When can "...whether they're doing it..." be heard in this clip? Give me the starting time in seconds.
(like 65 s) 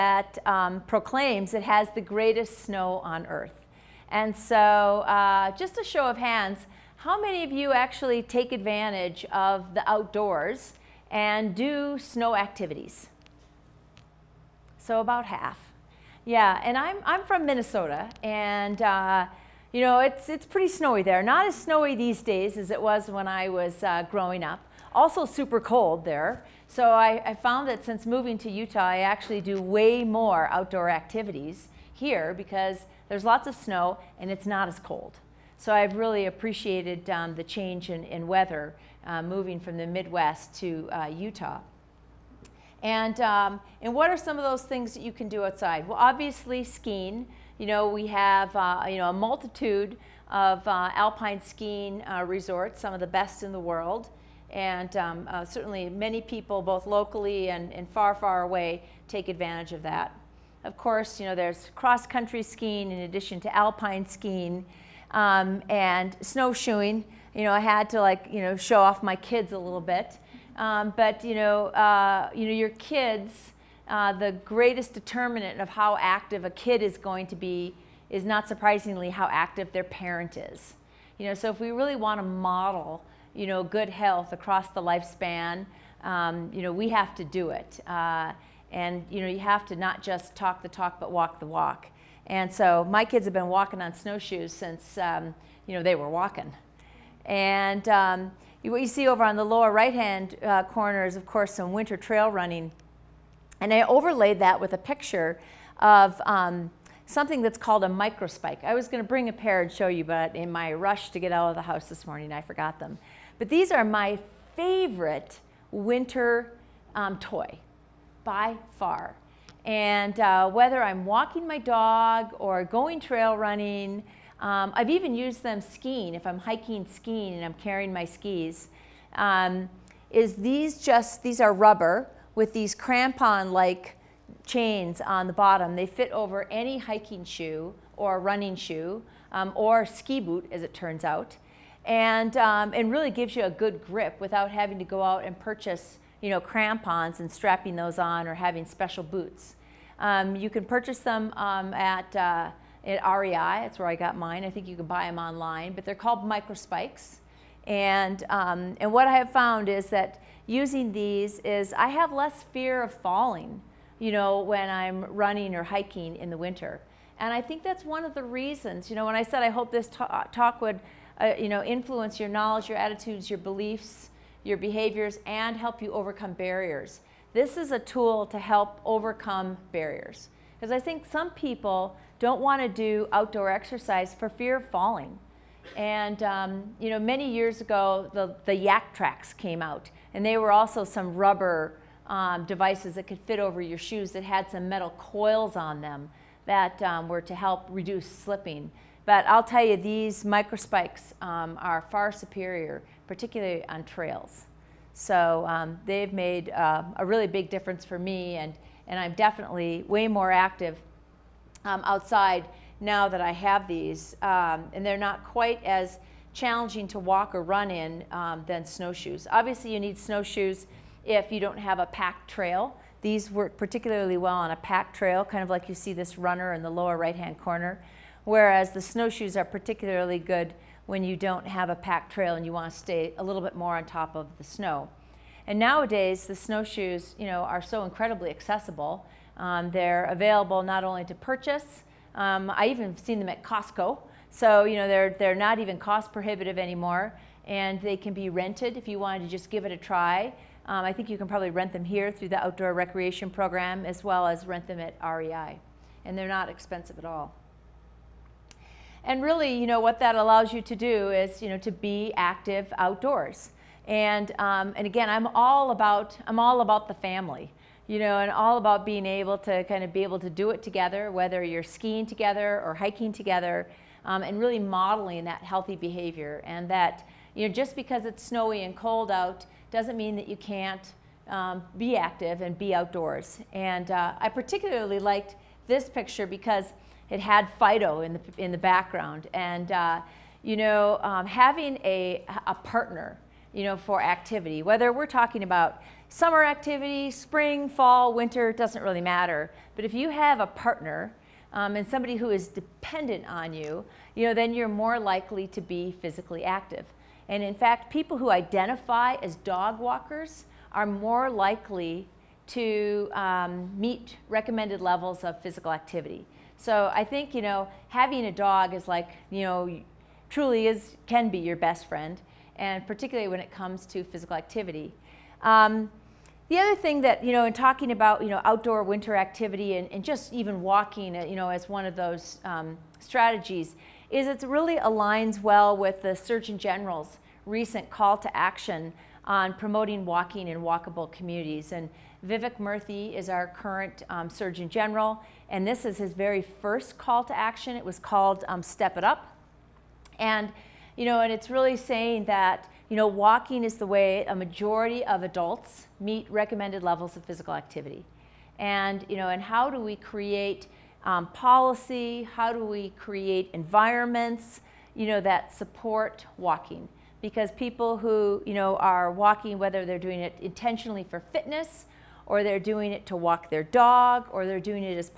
369 s.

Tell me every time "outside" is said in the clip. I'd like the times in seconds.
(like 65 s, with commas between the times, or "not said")
45 s, 211 s.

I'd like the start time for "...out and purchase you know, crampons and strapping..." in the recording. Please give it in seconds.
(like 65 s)
145 s.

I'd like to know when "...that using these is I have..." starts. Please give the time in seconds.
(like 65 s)
159 s.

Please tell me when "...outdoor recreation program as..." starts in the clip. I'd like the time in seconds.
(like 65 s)
252 s.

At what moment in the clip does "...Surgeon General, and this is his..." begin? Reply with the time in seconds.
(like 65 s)
344 s.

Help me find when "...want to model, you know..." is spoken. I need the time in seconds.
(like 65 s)
81 s.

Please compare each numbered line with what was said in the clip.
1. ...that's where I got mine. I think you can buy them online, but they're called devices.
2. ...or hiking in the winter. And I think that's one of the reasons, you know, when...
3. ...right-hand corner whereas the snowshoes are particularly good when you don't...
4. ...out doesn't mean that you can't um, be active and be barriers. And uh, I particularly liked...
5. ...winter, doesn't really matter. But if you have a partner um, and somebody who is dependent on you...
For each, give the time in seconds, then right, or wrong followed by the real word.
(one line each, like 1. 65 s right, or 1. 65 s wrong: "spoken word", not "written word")
1. 153 s wrong: "microspikes", not "devices"
2. 165 s right
3. 226 s right
4. 279 s wrong: "outdoors", not "barriers"
5. 298 s right.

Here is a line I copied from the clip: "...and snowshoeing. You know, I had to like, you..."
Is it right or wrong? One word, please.
right.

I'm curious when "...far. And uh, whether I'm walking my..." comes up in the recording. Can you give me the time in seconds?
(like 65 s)
118 s.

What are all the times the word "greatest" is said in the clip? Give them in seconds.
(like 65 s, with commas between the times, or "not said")
2 s, 74 s.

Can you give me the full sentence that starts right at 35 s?
So I've really appreciated um, the change in, in weather uh, moving from the Midwest to uh, Utah.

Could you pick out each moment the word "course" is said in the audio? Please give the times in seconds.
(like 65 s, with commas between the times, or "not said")
60 s, 101 s.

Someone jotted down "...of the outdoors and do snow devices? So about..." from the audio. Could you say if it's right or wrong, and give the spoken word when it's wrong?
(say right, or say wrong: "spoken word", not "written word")
wrong: "activities", not "devices".